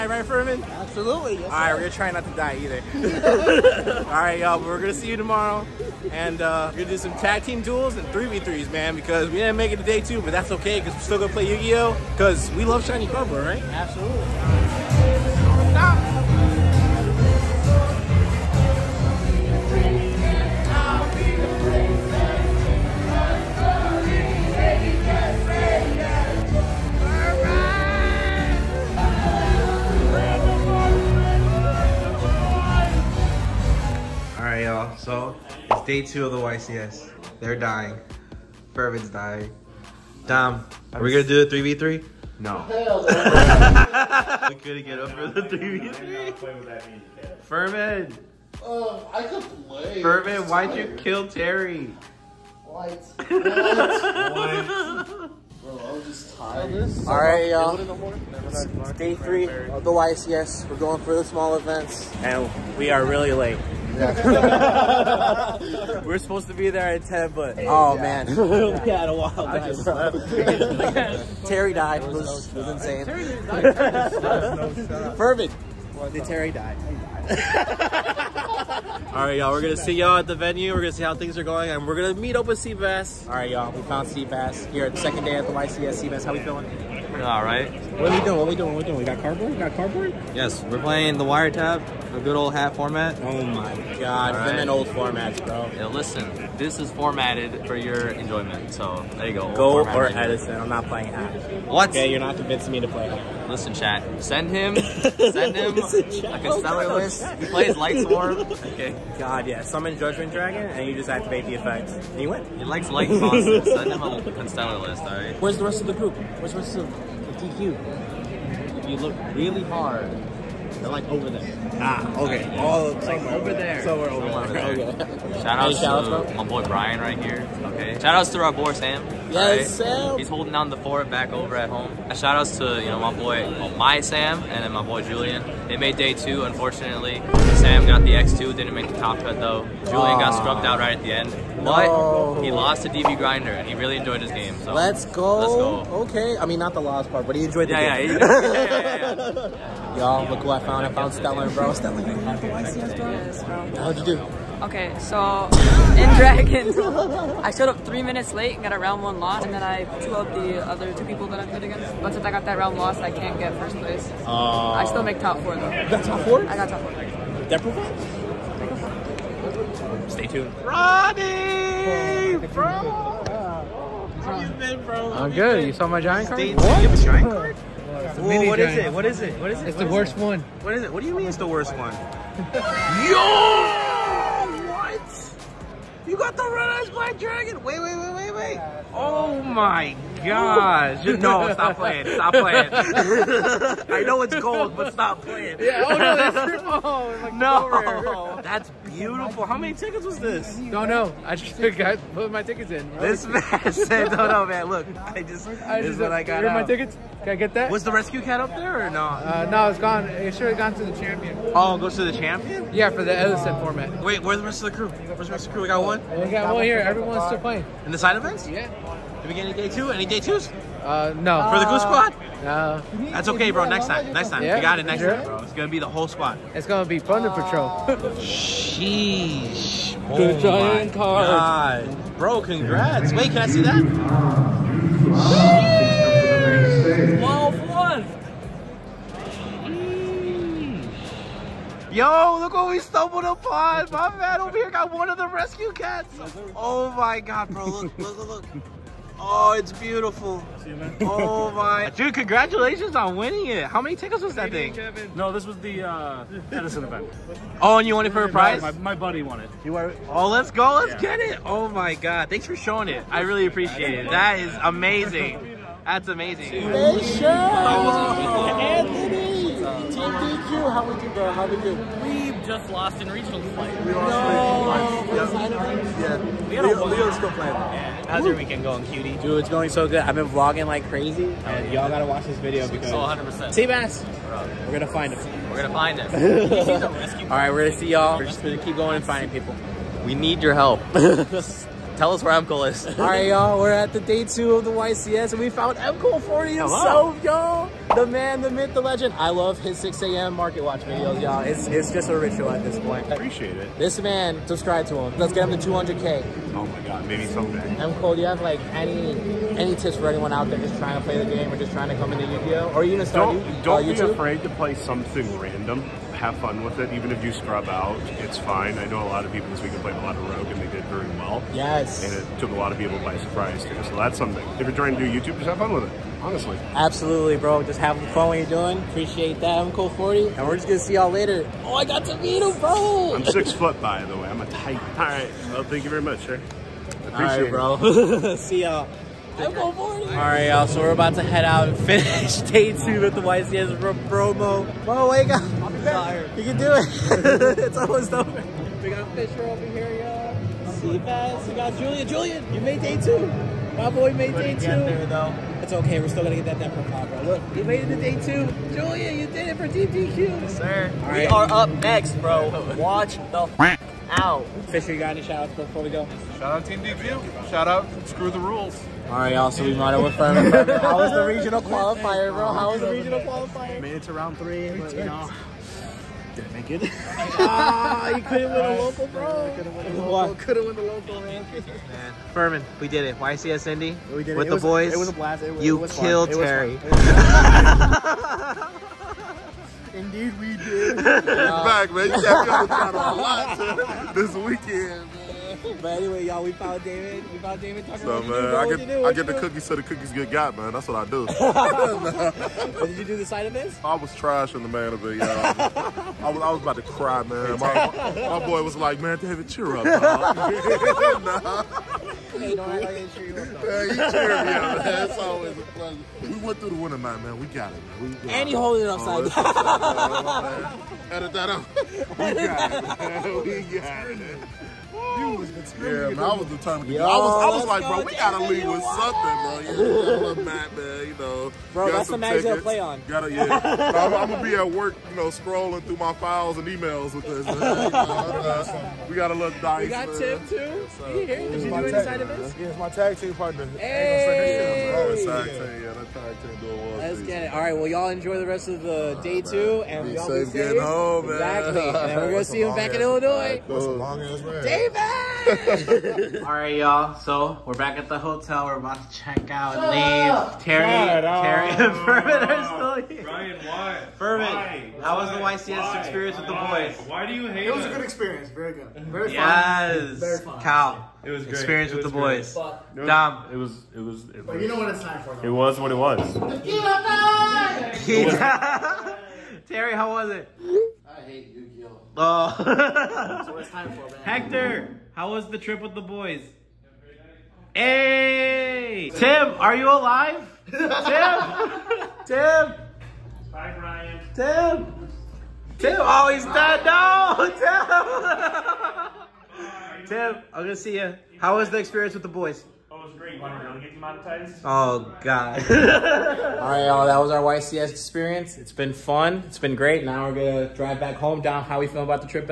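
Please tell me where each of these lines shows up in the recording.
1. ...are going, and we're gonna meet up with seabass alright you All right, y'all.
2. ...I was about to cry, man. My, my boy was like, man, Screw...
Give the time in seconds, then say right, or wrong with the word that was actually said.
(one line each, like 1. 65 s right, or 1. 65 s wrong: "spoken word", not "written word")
1. 81 s right
2. 406 s wrong: "David", not "Screw".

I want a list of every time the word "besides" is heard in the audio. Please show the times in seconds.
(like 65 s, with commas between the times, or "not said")
not said.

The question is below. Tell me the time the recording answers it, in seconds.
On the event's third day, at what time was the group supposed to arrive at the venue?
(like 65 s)
67 s.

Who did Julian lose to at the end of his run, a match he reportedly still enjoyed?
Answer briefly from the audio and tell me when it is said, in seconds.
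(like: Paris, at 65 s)
DB Grinder, at 142 s.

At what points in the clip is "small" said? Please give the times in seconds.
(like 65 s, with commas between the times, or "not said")
61 s.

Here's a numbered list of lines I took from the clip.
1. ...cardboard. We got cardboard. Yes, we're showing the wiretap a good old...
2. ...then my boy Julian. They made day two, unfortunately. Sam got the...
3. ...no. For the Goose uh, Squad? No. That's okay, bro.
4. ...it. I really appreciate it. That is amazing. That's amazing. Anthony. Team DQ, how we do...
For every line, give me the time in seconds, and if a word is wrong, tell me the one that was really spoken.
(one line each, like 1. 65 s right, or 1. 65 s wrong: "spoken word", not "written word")
1. 89 s wrong: "playing", not "showing"
2. 134 s right
3. 221 s right
4. 262 s right.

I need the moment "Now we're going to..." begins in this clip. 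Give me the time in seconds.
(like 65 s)
510 s.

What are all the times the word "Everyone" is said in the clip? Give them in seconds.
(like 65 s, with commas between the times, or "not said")
216 s.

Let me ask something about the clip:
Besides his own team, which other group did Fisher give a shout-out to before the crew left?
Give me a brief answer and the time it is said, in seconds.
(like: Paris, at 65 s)
Screw the Rules, at 368 s.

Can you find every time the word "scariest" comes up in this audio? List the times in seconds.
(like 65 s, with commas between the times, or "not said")
not said.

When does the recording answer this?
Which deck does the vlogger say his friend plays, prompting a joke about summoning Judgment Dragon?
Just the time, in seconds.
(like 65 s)
107 s.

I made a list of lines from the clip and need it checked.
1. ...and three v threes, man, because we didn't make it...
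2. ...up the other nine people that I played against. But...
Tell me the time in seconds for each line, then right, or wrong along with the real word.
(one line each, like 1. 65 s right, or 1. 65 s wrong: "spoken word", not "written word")
1. 7 s right
2. 160 s wrong: "two", not "nine".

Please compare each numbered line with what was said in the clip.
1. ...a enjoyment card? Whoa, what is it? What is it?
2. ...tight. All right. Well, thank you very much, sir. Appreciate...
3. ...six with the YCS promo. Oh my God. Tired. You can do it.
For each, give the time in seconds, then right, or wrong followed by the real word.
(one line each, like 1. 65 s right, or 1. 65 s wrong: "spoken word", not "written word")
1. 176 s wrong: "giant", not "enjoyment"
2. 334 s right
3. 342 s wrong: "two", not "six".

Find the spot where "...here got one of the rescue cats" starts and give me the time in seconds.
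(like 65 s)
244 s.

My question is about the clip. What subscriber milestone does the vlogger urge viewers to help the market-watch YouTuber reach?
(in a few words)
200K.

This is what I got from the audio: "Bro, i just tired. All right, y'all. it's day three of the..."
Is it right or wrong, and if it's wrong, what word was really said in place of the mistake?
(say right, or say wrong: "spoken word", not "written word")
right.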